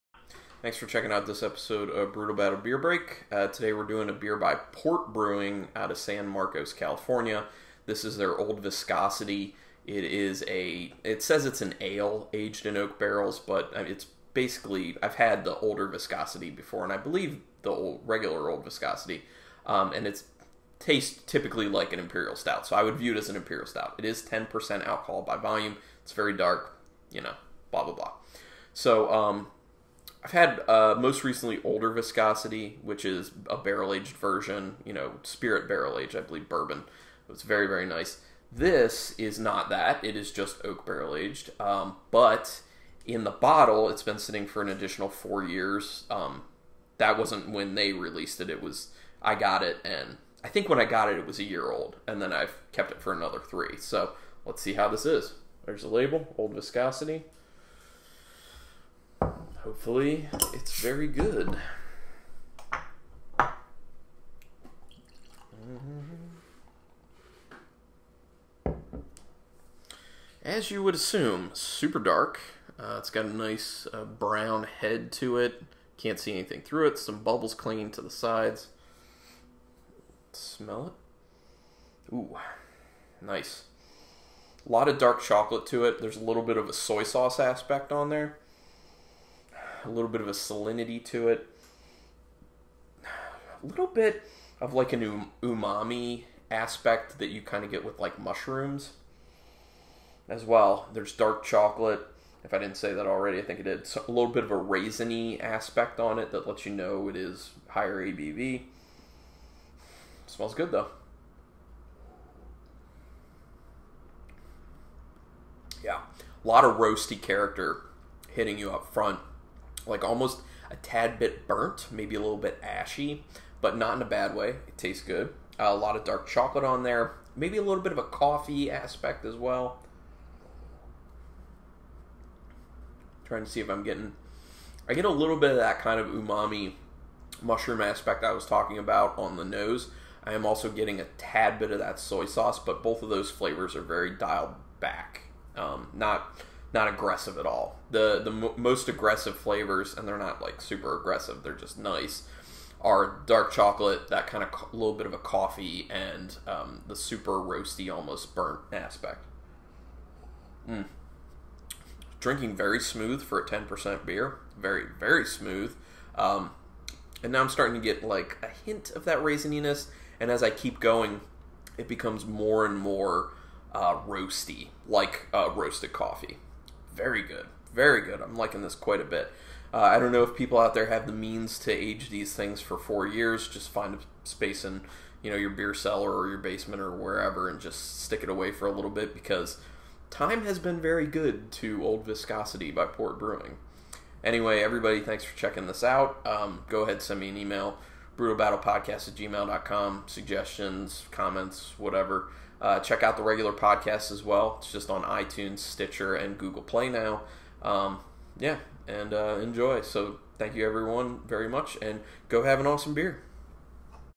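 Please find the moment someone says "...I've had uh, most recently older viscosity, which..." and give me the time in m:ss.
0:30.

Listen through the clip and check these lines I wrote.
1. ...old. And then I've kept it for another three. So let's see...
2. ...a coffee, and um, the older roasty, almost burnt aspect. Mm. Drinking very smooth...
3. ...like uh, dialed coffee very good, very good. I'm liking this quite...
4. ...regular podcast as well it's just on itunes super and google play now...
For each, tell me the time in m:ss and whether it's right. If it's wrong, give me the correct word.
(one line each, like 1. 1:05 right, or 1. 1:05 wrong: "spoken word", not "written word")
1. 0:51 right
2. 2:35 wrong: "super", not "older"
3. 2:54 wrong: "roasted", not "dialed"
4. 3:23 wrong: "stitcher", not "super".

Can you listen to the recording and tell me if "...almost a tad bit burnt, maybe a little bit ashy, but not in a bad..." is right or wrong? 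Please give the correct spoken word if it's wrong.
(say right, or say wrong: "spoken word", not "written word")
right.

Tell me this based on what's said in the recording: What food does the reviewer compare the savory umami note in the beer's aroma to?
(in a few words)
Mushrooms.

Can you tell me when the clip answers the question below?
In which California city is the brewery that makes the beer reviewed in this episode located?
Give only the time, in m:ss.
0:05.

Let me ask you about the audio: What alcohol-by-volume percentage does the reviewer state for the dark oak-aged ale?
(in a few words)
10%.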